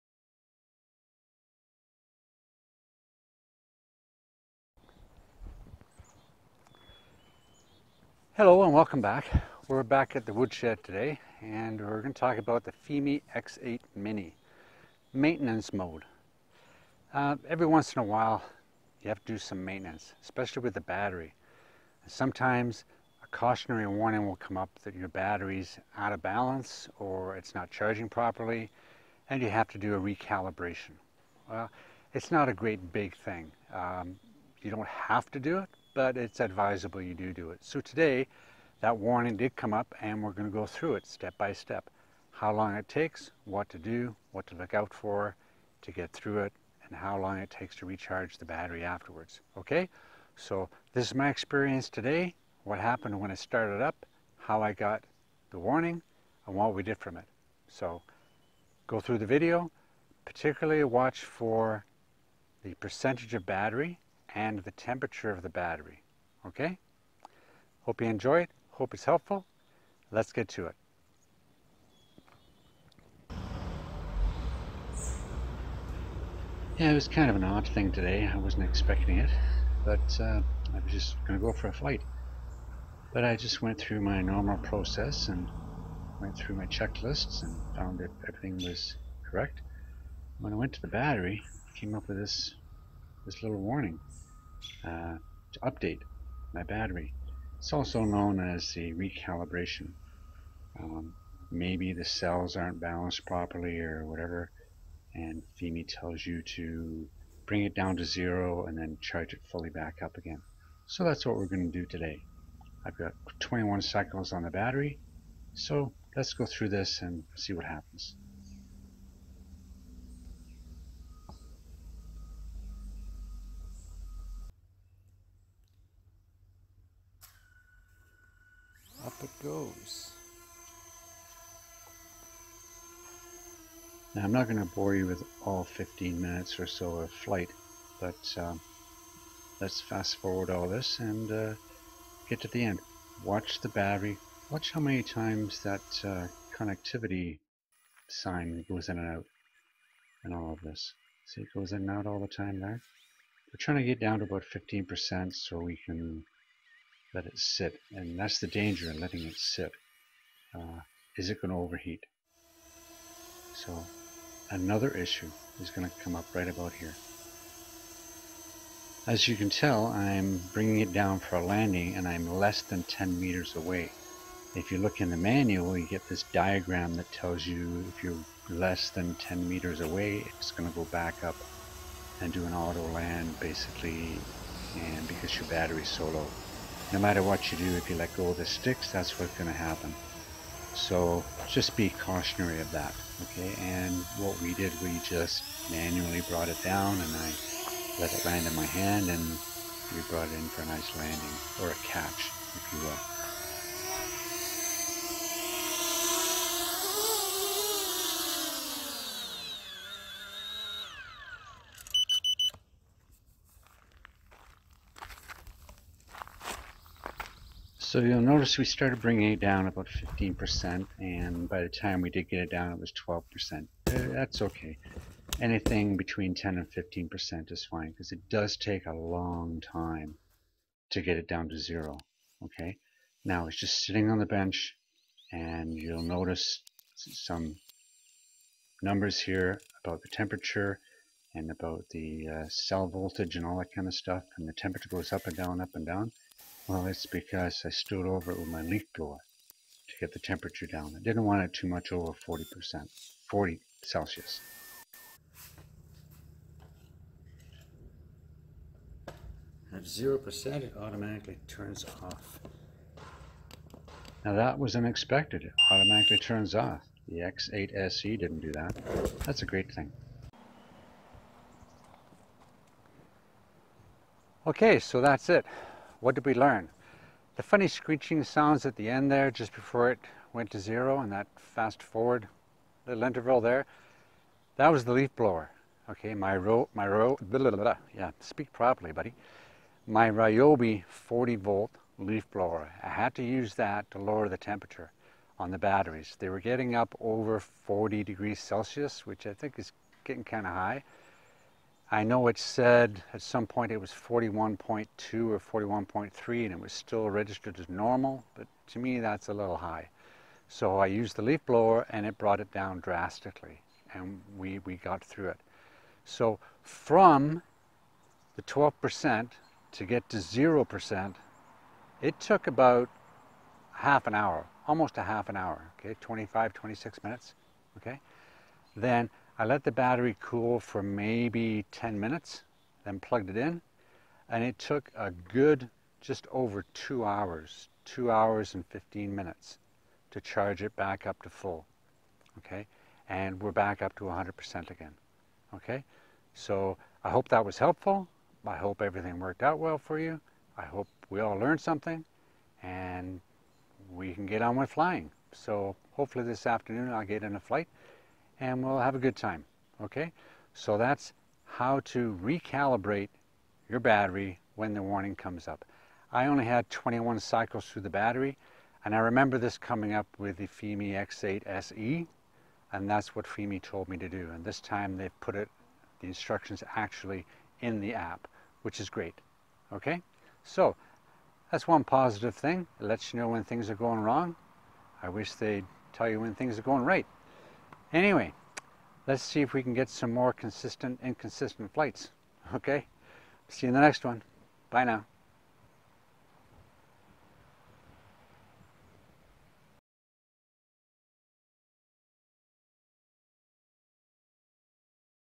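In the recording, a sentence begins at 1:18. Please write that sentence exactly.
I wasn't expecting it, but uh, I was just going to go for a flight.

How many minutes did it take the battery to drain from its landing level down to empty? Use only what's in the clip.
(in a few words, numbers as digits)
25, 26 minutes.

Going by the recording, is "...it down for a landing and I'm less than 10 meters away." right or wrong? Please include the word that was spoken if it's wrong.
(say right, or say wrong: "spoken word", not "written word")
right.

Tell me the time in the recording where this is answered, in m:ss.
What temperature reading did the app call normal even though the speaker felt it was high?
5:03.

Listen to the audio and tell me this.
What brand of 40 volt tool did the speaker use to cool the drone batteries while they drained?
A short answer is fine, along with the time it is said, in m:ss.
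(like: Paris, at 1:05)
Ryobi, at 4:50.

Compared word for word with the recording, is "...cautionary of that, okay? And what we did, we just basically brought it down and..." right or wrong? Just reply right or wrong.
wrong.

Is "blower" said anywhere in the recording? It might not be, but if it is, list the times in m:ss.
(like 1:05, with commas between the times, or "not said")
4:08, 4:45, 4:52, 5:11.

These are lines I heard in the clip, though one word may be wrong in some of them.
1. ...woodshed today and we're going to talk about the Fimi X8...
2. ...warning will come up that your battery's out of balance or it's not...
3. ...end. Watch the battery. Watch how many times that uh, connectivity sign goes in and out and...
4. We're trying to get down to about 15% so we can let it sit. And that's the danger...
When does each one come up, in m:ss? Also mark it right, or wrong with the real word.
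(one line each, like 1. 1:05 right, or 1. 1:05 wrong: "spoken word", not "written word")
1. 0:10 right
2. 0:23 right
3. 2:22 right
4. 2:33 right.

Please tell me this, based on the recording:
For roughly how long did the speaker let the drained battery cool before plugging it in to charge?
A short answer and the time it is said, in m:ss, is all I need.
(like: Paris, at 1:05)
10 minutes, at 5:30.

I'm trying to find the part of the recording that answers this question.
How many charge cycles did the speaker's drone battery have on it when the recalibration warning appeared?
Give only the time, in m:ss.
1:53.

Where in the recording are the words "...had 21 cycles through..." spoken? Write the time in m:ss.
6:06.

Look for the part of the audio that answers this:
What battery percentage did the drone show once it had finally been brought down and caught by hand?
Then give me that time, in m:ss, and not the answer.
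3:42.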